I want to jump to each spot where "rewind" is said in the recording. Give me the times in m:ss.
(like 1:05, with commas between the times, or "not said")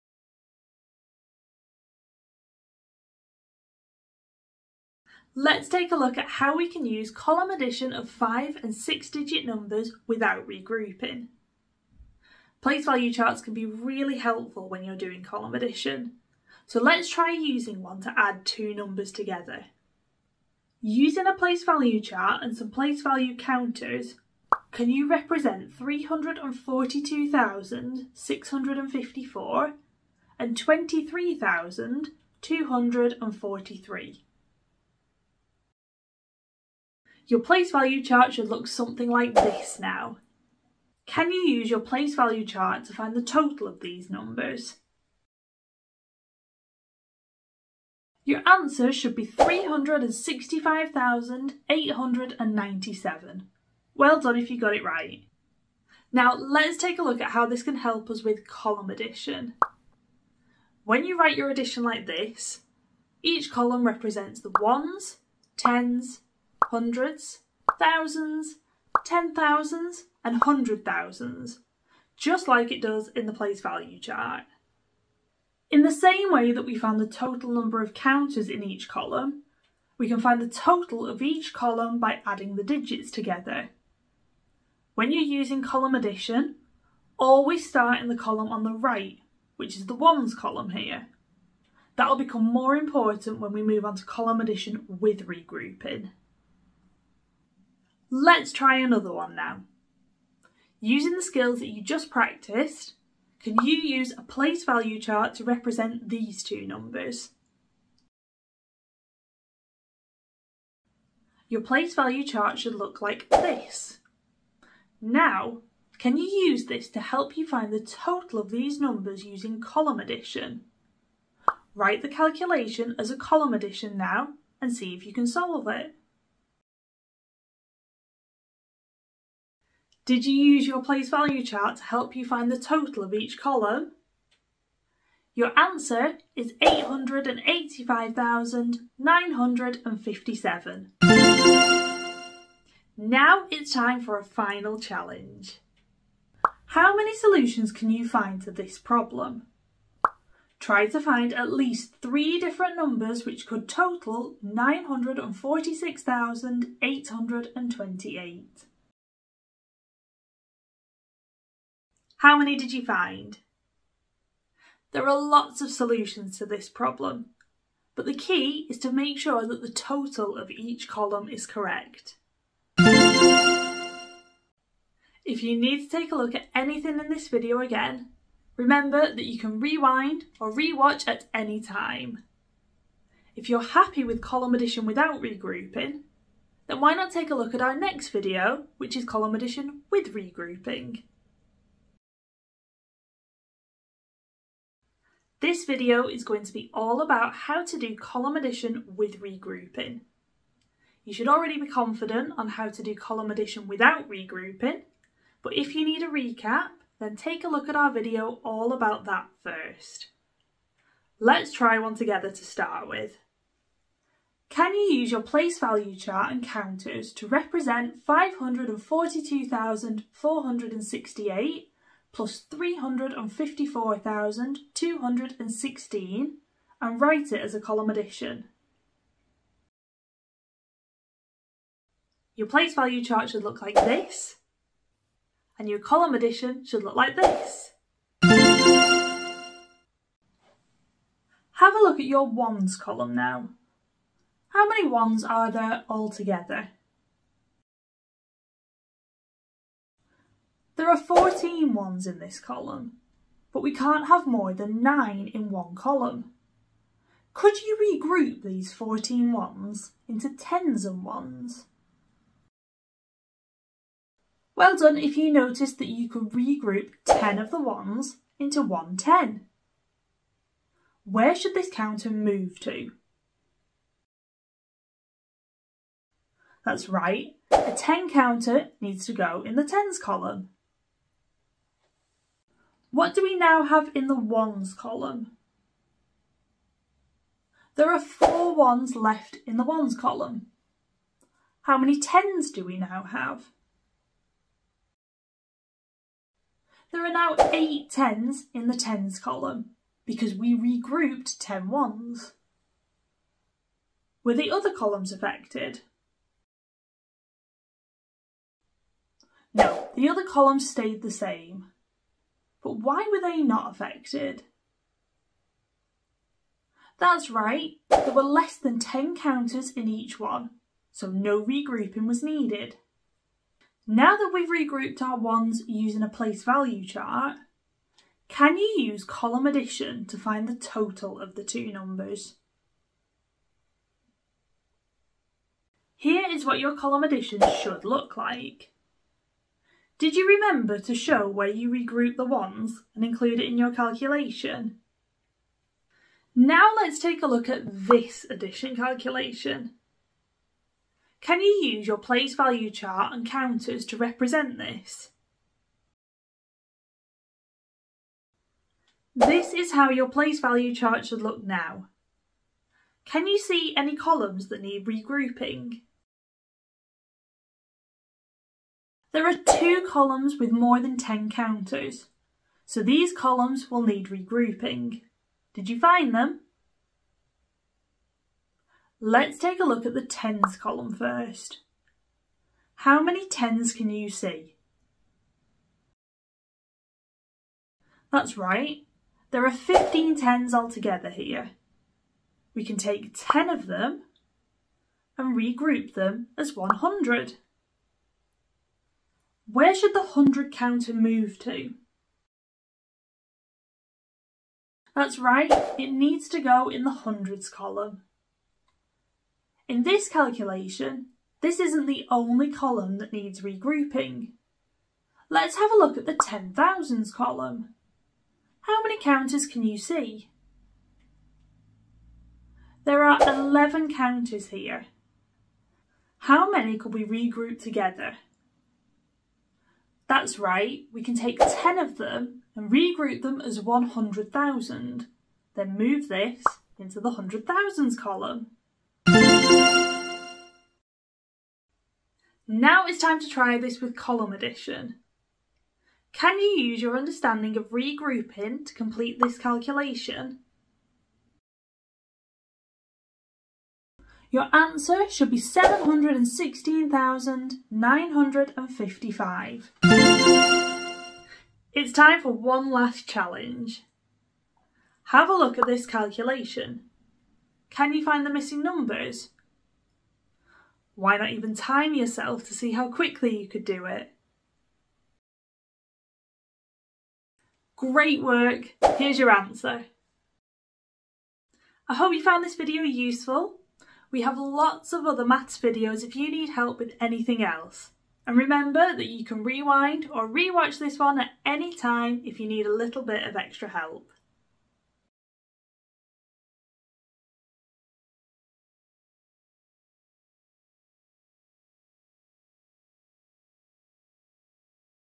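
2:59, 8:09.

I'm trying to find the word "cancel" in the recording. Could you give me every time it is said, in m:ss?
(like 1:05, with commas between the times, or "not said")
not said.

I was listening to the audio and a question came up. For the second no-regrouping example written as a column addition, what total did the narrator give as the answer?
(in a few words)
885,957.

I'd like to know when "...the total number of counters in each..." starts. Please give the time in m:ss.
1:17.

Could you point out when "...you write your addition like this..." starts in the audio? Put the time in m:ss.
1:01.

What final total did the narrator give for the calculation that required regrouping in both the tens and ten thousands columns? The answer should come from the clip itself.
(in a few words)
716,955.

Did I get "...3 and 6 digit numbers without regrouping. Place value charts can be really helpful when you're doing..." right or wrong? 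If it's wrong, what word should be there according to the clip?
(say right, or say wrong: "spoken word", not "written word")
wrong: "5", not "3".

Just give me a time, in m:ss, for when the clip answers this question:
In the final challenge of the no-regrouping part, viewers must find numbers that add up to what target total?
2:34.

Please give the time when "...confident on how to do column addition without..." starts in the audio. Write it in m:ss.
3:21.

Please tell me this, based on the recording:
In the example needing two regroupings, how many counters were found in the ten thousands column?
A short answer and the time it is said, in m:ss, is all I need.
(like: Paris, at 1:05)
11, at 7:03.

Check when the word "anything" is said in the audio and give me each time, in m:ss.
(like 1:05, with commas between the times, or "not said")
2:56, 8:06.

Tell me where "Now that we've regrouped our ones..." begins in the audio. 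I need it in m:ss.
5:23.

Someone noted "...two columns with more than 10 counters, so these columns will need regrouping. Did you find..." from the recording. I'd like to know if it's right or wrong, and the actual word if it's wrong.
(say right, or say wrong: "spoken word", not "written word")
right.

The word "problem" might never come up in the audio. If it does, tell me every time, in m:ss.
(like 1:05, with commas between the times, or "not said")
2:28, 2:46.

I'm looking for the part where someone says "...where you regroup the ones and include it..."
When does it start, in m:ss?
5:41.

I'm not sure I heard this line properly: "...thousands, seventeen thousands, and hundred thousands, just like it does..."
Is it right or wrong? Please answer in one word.
wrong.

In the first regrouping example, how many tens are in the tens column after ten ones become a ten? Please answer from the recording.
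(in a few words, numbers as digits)
8.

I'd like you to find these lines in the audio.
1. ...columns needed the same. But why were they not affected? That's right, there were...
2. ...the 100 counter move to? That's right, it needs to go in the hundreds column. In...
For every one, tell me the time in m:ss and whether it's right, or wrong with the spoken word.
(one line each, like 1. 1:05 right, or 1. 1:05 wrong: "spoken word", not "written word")
1. 5:10 wrong: "stayed", not "needed"
2. 6:39 right.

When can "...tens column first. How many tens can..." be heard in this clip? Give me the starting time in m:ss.
6:20.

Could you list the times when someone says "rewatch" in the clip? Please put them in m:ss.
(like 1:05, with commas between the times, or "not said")
3:00, 8:10.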